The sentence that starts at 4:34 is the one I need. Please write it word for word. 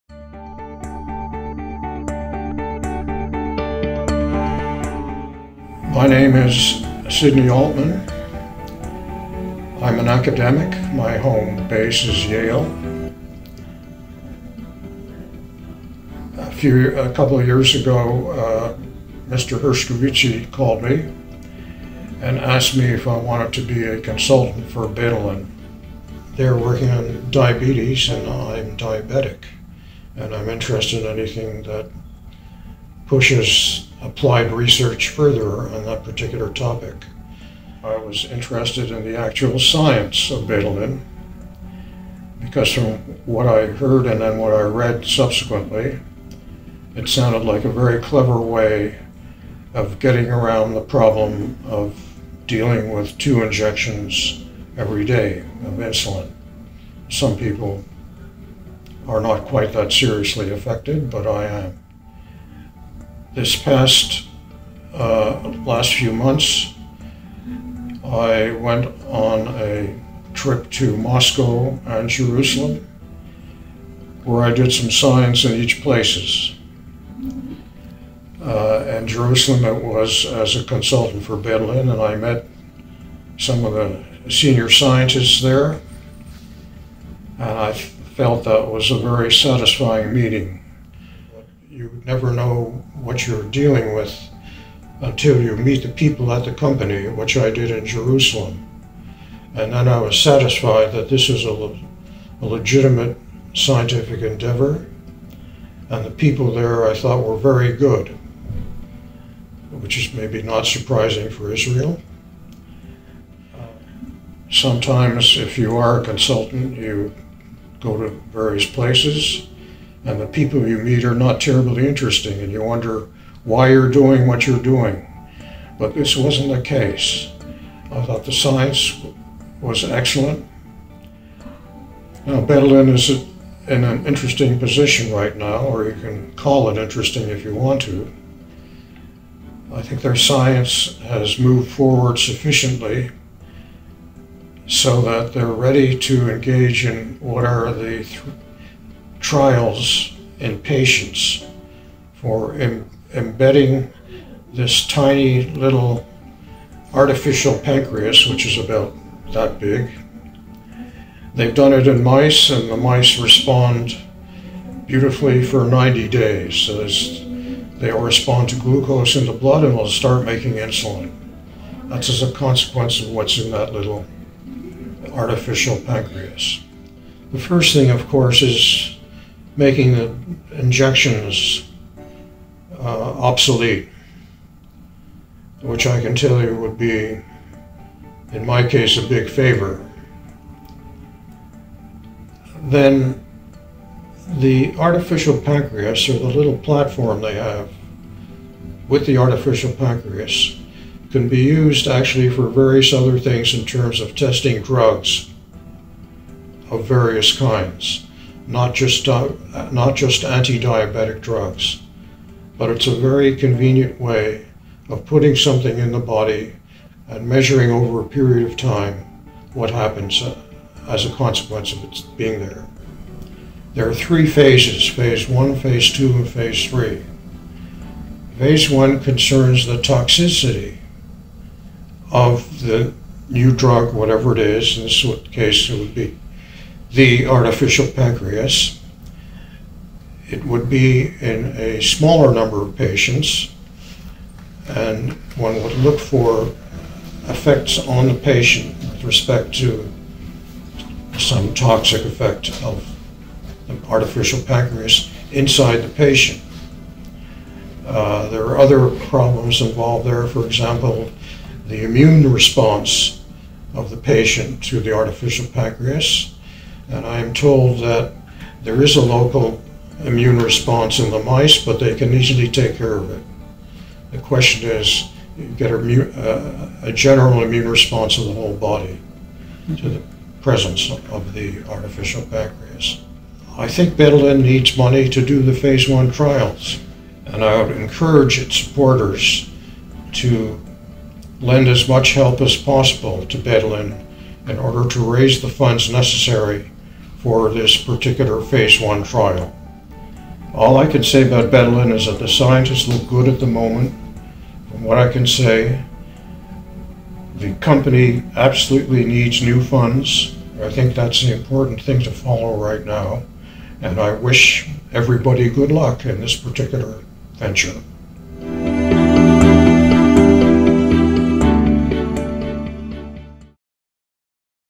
The question is, you get a, uh, a general immune response of the whole body to the presence of the artificial pancreas.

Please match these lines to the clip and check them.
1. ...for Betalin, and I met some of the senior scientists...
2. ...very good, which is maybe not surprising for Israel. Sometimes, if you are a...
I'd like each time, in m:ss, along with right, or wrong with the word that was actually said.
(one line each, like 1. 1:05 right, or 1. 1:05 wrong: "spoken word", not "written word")
1. 1:21 right
2. 1:47 right.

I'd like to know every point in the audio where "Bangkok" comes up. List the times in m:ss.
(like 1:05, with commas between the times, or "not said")
not said.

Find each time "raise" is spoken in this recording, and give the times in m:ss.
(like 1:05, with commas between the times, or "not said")
4:54.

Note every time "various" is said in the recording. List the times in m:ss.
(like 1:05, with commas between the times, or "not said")
1:58, 3:22, 3:26.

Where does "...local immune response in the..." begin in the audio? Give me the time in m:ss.
4:29.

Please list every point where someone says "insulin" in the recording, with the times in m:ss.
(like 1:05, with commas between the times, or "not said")
0:55, 2:50.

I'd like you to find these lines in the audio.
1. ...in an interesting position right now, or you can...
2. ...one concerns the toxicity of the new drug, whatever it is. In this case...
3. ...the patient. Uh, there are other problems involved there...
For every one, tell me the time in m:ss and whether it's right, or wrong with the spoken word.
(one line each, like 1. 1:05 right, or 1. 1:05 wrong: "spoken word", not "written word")
1. 2:13 right
2. 3:48 right
3. 4:15 right.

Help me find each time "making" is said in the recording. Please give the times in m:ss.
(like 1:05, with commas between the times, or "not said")
2:50, 2:59.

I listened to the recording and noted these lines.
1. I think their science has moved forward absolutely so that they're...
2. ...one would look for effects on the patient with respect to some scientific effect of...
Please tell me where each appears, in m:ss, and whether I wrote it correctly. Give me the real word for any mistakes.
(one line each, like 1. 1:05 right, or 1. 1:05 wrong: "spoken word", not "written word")
1. 2:19 wrong: "sufficiently", not "absolutely"
2. 4:05 wrong: "toxic", not "scientific".